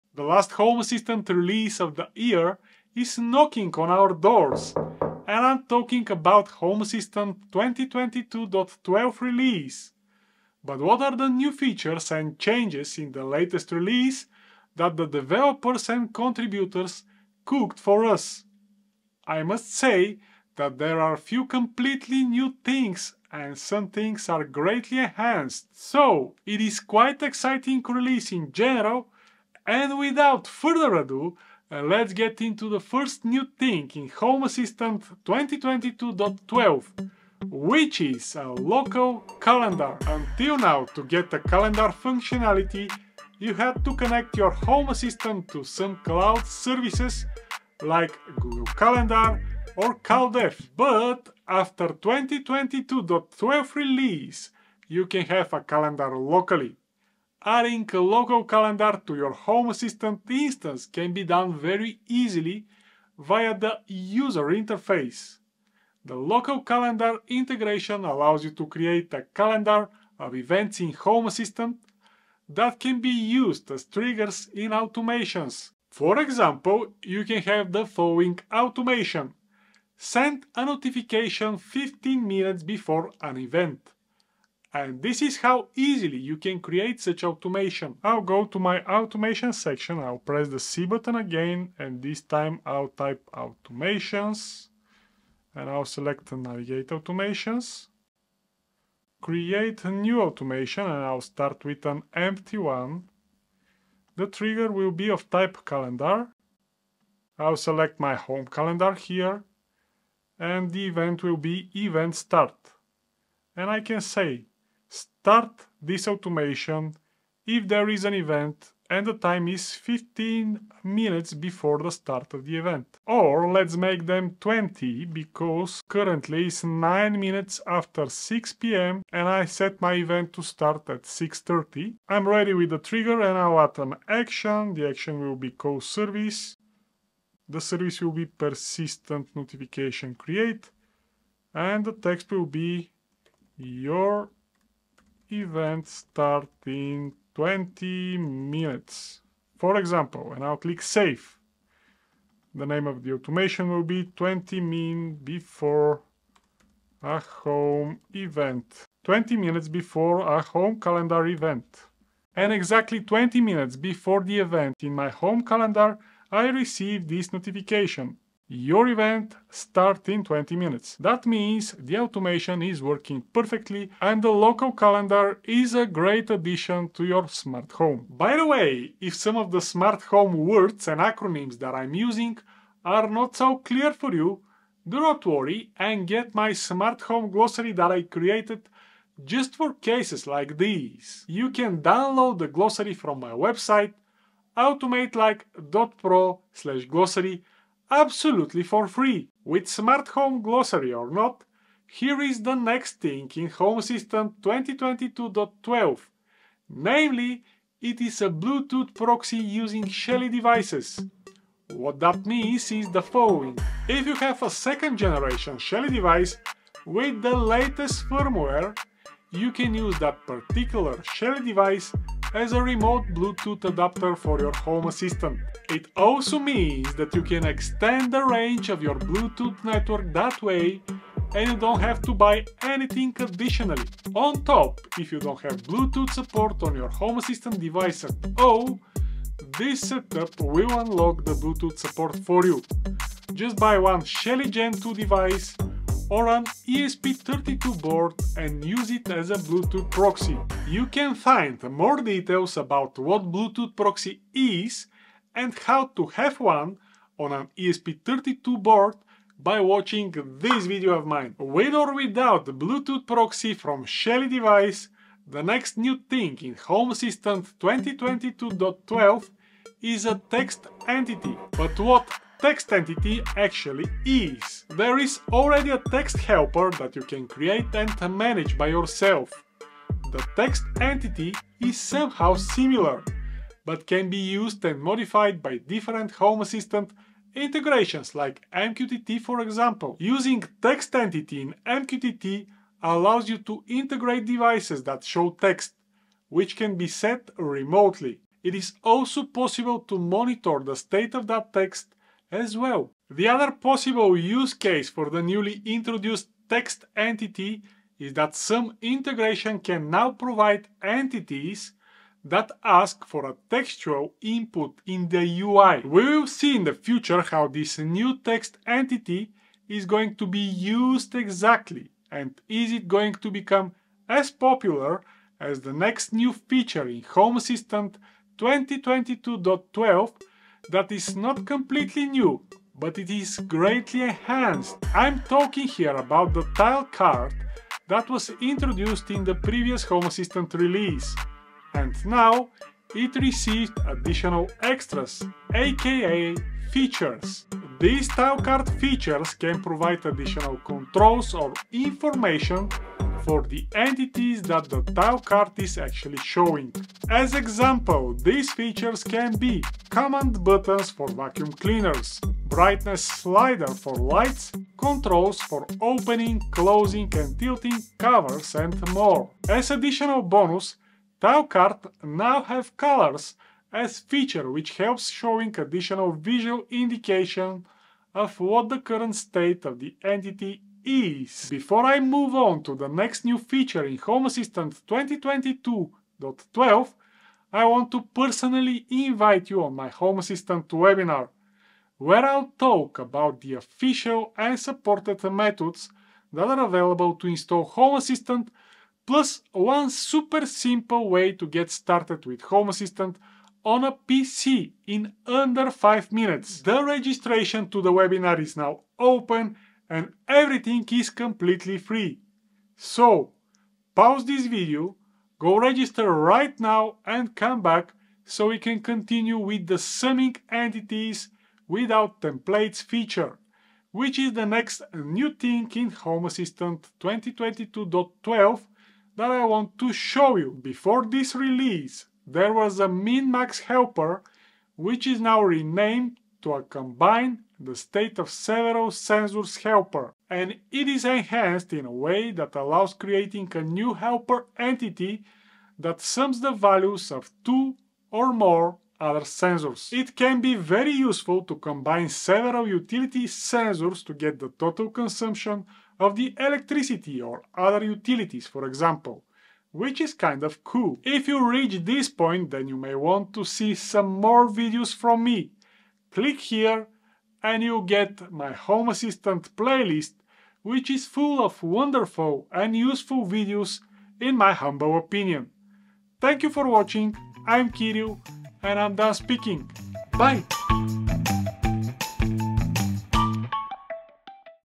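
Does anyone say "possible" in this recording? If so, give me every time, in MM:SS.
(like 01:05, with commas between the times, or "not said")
04:59, 05:03.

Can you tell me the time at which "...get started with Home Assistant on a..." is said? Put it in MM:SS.
06:41.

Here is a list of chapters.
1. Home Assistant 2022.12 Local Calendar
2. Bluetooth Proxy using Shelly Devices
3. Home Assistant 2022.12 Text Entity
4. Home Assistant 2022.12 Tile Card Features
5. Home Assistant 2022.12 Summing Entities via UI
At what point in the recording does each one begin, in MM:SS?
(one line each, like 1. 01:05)
1. 00:31
2. 03:21
3. 04:24
4. 05:25
5. 06:58.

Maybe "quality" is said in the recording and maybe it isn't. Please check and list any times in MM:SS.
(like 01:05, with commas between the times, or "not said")
not said.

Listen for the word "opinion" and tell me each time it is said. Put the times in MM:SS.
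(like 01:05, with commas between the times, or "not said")
07:54.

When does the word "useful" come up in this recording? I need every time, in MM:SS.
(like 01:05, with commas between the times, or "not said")
07:30, 07:52.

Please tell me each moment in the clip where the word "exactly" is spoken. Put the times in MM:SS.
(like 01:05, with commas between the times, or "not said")
02:42, 05:21.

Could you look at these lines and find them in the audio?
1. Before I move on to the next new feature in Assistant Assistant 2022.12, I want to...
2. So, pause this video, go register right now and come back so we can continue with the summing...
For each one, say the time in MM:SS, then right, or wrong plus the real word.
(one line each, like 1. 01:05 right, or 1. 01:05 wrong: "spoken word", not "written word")
1. 06:21 wrong: "Home", not "Assistant"
2. 06:52 right.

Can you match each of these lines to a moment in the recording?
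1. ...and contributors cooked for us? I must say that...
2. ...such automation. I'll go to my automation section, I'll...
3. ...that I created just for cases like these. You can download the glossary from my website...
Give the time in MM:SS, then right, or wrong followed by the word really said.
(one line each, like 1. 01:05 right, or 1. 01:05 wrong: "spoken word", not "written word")
1. 00:15 right
2. 01:27 right
3. 03:07 right.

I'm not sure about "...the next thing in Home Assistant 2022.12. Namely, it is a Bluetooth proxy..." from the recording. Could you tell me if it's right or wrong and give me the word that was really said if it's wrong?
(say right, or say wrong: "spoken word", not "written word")
right.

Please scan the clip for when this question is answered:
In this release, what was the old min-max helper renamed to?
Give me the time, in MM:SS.
07:16.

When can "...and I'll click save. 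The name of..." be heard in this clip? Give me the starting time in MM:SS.
02:30.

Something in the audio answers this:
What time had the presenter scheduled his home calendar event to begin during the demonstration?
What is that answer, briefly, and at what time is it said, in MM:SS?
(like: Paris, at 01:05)
6.30, at 02:11.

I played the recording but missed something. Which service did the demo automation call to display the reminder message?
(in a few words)
persistent notification create.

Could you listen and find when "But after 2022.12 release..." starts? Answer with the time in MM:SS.
00:50.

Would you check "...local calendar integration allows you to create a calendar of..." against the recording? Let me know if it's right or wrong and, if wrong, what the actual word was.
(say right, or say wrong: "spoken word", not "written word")
right.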